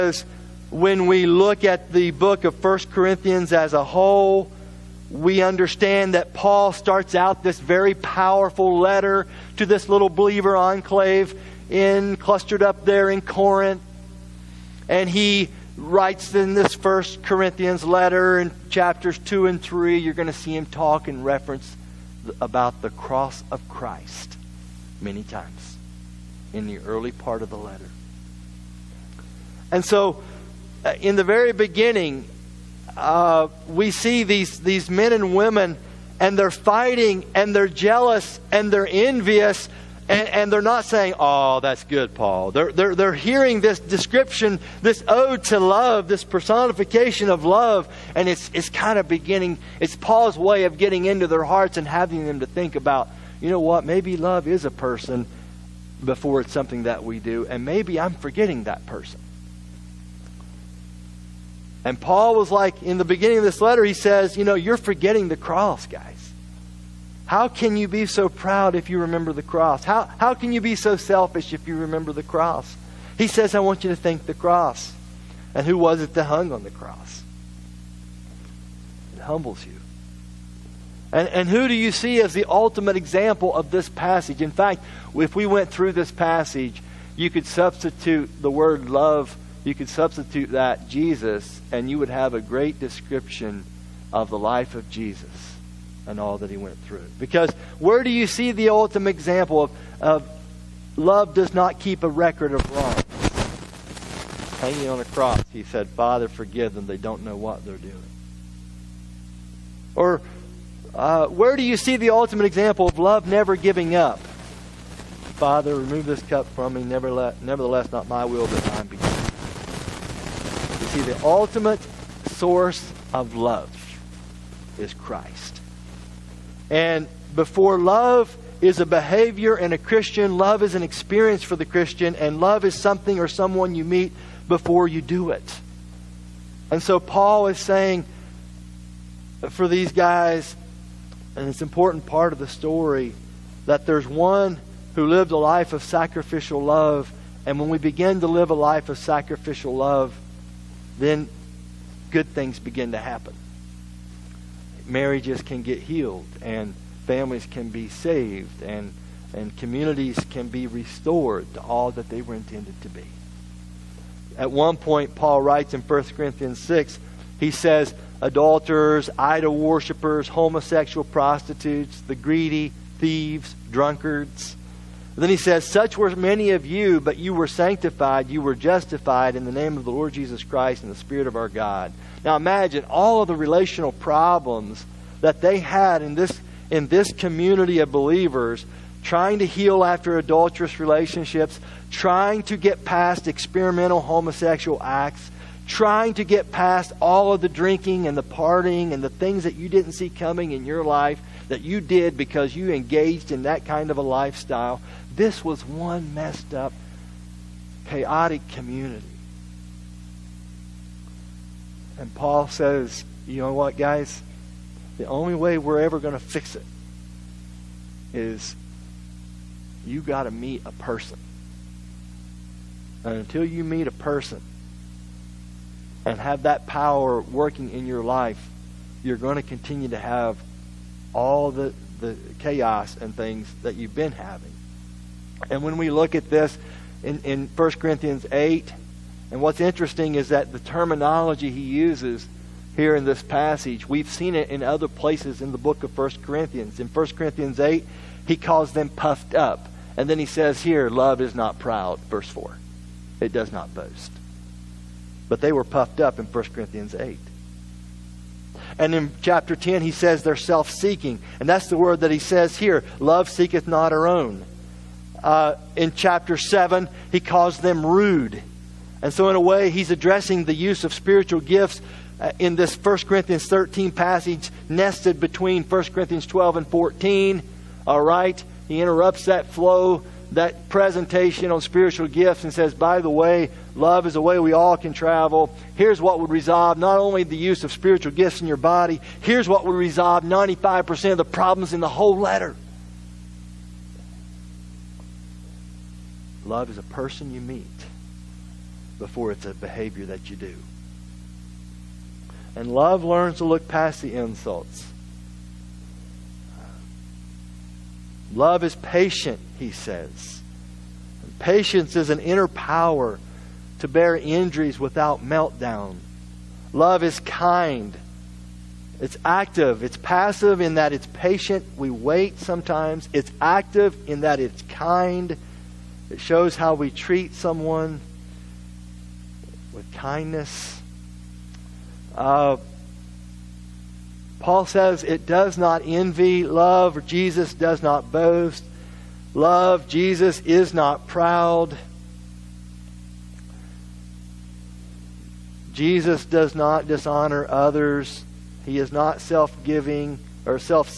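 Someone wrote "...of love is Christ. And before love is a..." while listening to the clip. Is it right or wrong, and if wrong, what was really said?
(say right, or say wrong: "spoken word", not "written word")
right.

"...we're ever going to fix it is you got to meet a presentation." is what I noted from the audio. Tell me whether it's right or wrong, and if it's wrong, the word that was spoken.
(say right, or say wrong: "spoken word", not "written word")
wrong: "person", not "presentation".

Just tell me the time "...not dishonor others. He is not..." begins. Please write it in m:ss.
5:46.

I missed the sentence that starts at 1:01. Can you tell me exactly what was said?
And Paul was like, in the beginning of this letter, he says, You know, you're forgetting the cross, guys.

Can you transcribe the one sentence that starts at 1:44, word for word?
Hanging on a cross, he said, Father, forgive them.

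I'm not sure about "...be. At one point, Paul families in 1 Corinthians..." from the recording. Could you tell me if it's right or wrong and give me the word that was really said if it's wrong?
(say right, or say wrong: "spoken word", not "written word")
wrong: "writes", not "families".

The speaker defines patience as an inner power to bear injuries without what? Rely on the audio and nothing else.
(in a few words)
meltdown.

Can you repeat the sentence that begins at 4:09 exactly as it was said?
And then he says here, love is not proud, verse 4.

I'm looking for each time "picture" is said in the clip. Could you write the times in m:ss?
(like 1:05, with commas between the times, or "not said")
not said.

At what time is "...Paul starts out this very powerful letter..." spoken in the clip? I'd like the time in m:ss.
0:06.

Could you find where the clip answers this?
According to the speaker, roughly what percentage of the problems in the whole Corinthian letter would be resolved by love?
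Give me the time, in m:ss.
4:50.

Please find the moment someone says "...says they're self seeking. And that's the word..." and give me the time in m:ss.
4:19.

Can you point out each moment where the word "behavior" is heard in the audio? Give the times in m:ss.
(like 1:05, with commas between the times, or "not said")
2:08, 4:59.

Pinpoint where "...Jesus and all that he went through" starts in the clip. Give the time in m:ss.
1:34.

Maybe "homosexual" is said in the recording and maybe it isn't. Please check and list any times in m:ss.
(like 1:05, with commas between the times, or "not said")
2:50, 3:13.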